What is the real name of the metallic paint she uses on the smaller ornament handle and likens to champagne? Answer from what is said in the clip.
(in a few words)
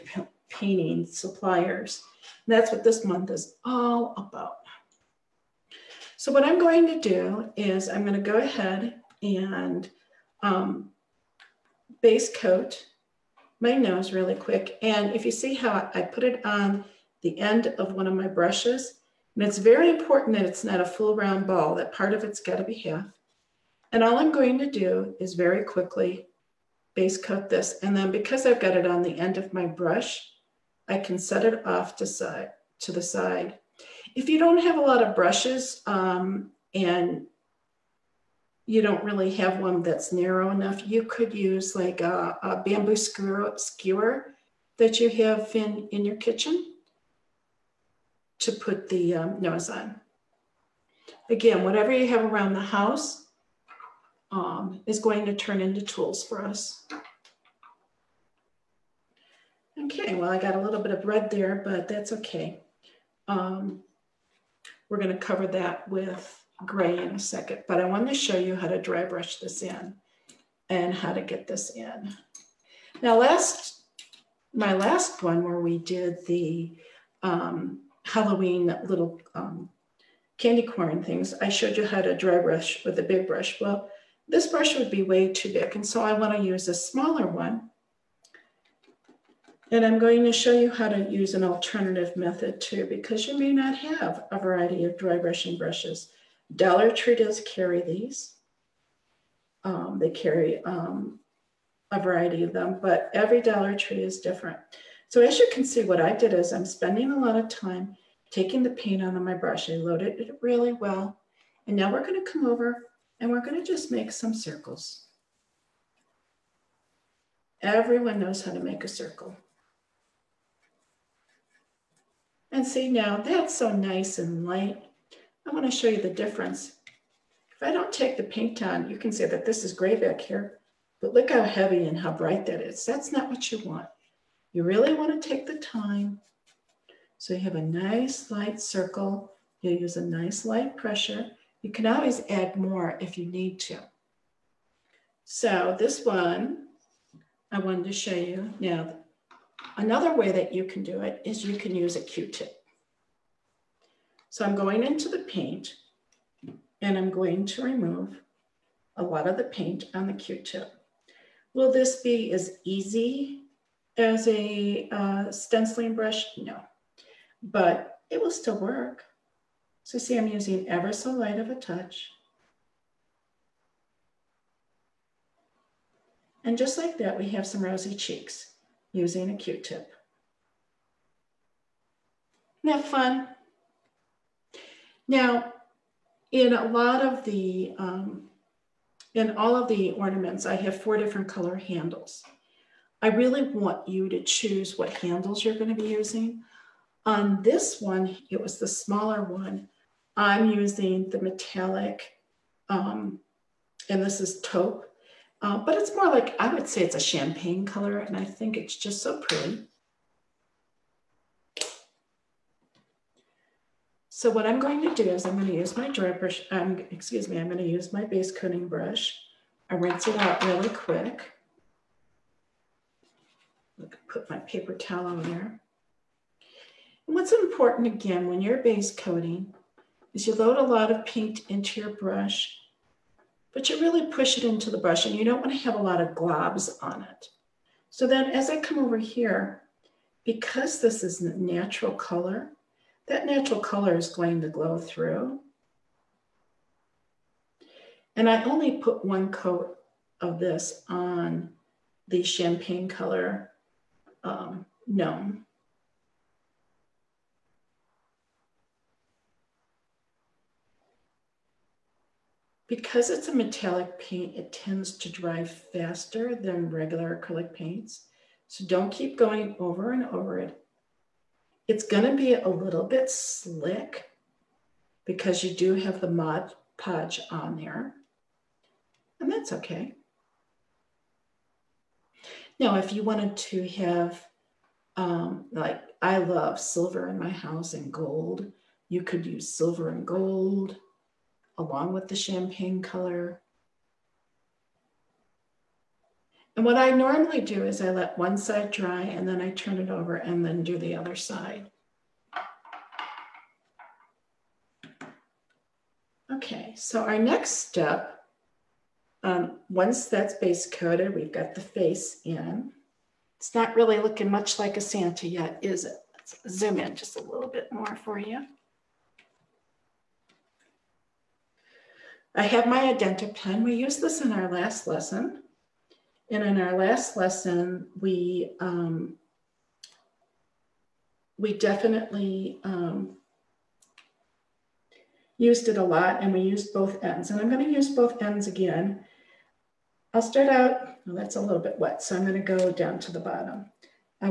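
taupe.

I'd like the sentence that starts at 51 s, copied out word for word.
Again, whatever you have around the house um, is going to turn into tools for us.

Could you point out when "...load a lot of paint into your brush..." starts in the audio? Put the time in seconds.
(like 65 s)
230 s.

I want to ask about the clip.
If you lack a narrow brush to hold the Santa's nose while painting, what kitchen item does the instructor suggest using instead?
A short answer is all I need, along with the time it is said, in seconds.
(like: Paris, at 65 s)
bamboo skewer, at 42 s.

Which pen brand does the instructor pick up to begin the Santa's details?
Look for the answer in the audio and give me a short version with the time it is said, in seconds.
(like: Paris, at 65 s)
Identi-Pen, at 322 s.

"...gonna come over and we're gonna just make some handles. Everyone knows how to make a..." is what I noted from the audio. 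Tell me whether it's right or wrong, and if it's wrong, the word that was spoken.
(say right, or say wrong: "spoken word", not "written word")
wrong: "circles", not "handles".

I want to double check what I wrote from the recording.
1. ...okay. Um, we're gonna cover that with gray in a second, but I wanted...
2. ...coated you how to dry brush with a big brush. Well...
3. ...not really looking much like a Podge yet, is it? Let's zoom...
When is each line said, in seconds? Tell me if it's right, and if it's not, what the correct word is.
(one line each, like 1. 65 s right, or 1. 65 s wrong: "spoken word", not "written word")
1. 62 s right
2. 81 s wrong: "showed", not "coated"
3. 313 s wrong: "Santa", not "Podge".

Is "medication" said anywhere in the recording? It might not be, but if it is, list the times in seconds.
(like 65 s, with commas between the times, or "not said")
not said.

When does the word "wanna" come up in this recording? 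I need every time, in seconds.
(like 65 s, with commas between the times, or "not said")
86 s, 125 s.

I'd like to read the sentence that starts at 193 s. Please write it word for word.
I really want you to choose what handles you're going to be using.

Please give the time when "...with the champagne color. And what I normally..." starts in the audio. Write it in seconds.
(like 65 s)
291 s.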